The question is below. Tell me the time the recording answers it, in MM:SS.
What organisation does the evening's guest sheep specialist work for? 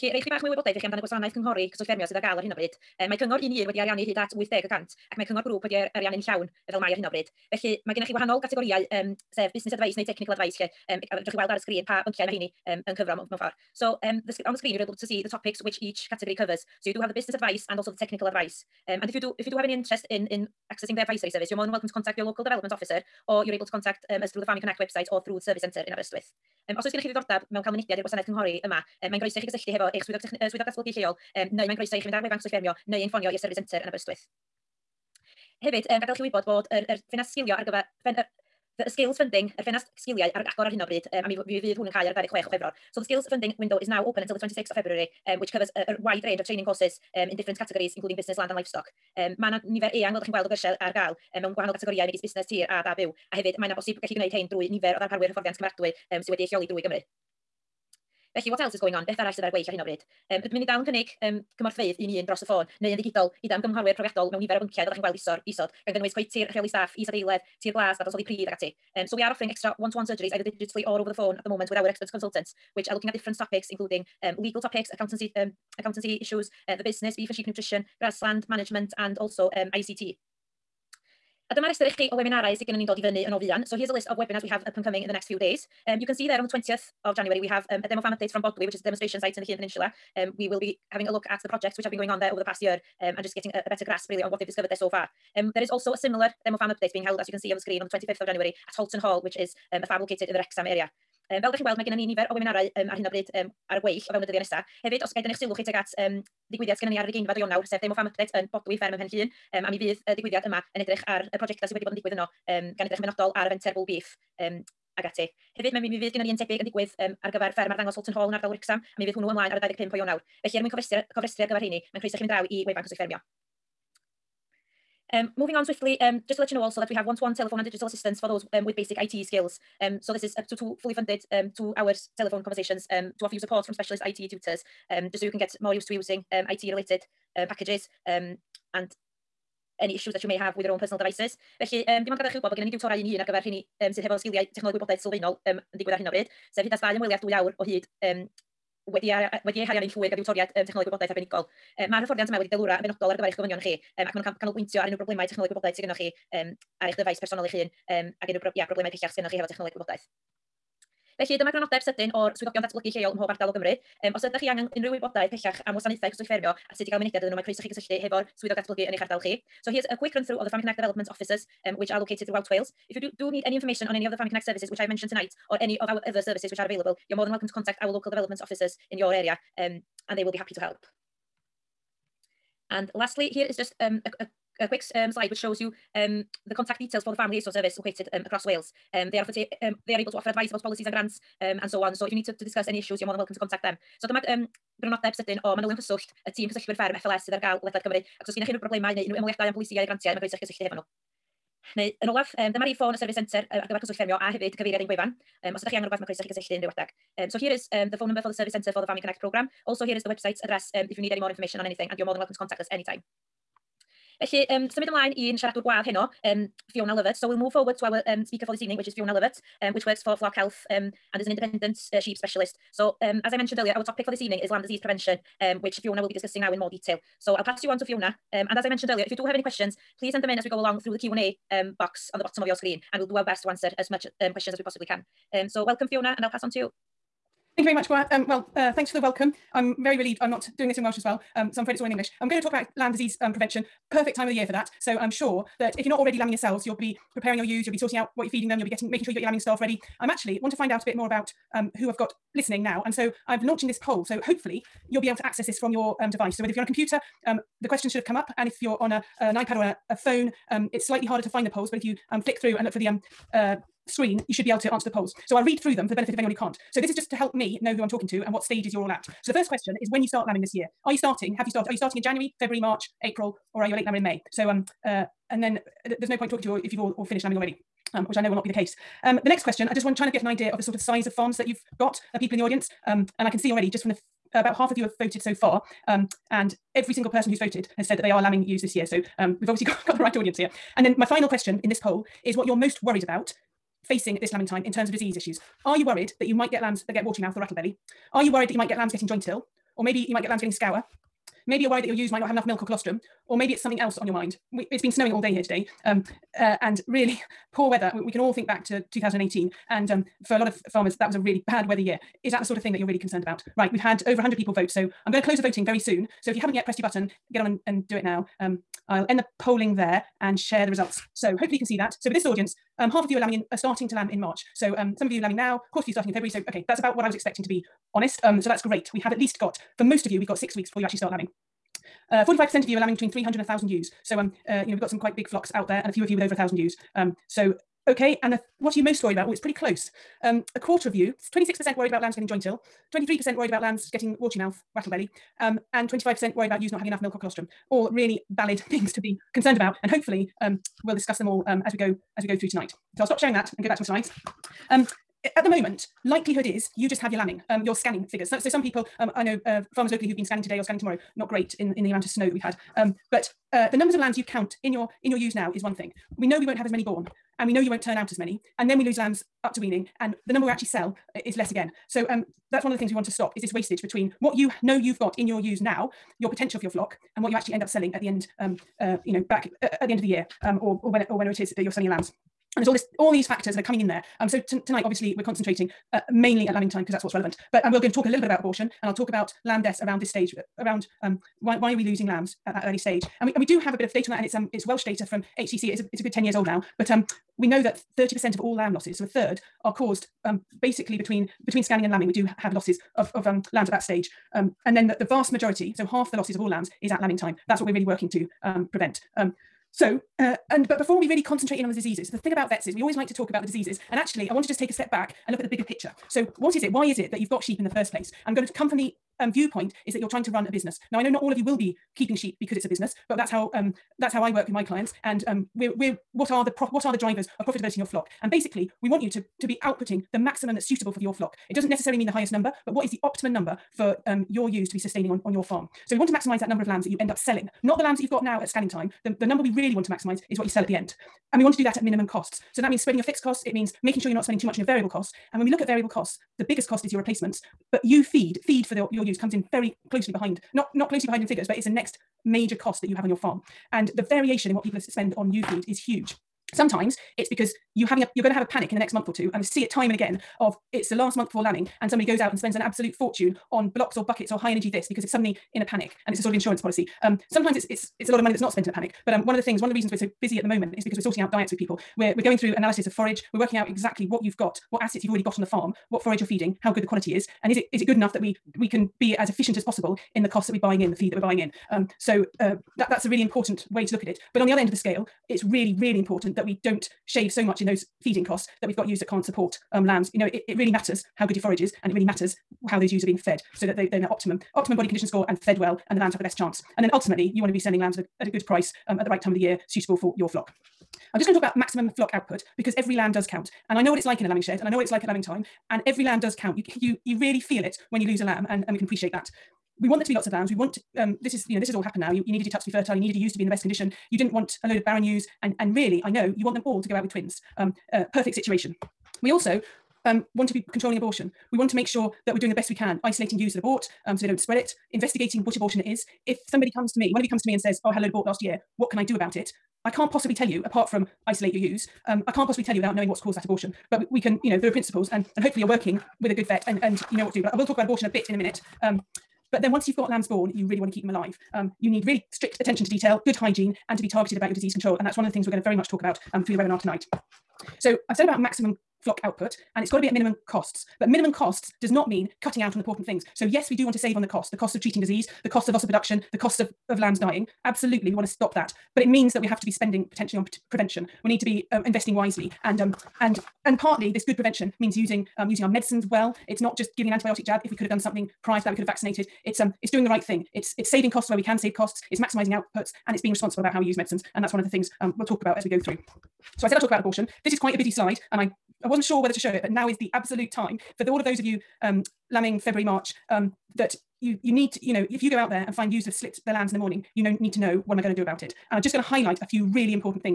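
03:40.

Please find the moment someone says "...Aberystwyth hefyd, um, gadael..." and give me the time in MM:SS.
00:33.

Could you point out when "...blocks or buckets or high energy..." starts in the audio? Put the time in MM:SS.
07:43.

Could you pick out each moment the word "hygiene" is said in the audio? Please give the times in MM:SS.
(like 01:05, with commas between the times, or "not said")
09:03.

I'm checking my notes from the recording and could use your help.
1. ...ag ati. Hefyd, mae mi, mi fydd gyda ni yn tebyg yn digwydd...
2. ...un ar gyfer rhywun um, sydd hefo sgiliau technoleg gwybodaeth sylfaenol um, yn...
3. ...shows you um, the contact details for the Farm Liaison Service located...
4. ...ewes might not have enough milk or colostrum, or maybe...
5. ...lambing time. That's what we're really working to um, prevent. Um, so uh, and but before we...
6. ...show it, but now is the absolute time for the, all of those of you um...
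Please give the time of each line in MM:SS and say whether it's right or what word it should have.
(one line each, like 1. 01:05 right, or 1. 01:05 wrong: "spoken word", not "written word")
1. 01:54 right
2. 02:23 right
3. 03:05 right
4. 05:01 right
5. 06:47 right
6. 09:39 right.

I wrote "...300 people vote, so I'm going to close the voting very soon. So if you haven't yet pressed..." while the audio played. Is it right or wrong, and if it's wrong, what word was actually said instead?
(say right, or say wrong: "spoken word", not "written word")
wrong: "100", not "300".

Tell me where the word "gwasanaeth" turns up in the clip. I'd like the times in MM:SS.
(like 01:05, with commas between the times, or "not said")
00:01, 00:28.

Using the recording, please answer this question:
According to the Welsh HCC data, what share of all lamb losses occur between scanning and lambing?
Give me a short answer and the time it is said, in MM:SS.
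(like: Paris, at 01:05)
30%, at 06:37.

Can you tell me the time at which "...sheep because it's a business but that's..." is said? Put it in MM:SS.
07:02.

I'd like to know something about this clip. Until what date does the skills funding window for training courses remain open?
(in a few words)
26th of February.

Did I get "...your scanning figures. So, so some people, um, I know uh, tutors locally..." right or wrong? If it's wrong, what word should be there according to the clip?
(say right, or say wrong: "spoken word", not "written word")
wrong: "farmers", not "tutors".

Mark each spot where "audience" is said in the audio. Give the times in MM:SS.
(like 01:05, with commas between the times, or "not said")
04:42, 04:50, 05:22.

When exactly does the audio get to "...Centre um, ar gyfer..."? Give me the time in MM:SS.
03:23.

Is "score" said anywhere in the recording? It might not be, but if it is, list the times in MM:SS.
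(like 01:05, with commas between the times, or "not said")
08:15.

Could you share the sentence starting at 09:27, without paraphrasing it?
If we could have done something prior to that, we could have vaccinated.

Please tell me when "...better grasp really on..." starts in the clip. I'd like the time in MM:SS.
01:33.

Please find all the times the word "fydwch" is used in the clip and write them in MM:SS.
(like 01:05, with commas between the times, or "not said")
00:11.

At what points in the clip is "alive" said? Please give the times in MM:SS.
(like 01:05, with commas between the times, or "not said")
09:01.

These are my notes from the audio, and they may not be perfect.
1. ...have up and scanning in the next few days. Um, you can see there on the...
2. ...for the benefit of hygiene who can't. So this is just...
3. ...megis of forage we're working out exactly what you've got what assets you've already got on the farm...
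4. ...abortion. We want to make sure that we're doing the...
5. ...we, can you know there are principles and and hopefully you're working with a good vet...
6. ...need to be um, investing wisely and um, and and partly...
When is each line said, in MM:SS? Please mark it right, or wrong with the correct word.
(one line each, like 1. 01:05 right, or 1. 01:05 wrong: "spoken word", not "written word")
1. 01:24 wrong: "coming", not "scanning"
2. 04:25 wrong: "anyone", not "hygiene"
3. 07:52 wrong: "analysis", not "megis"
4. 08:40 right
5. 08:54 right
6. 09:21 right.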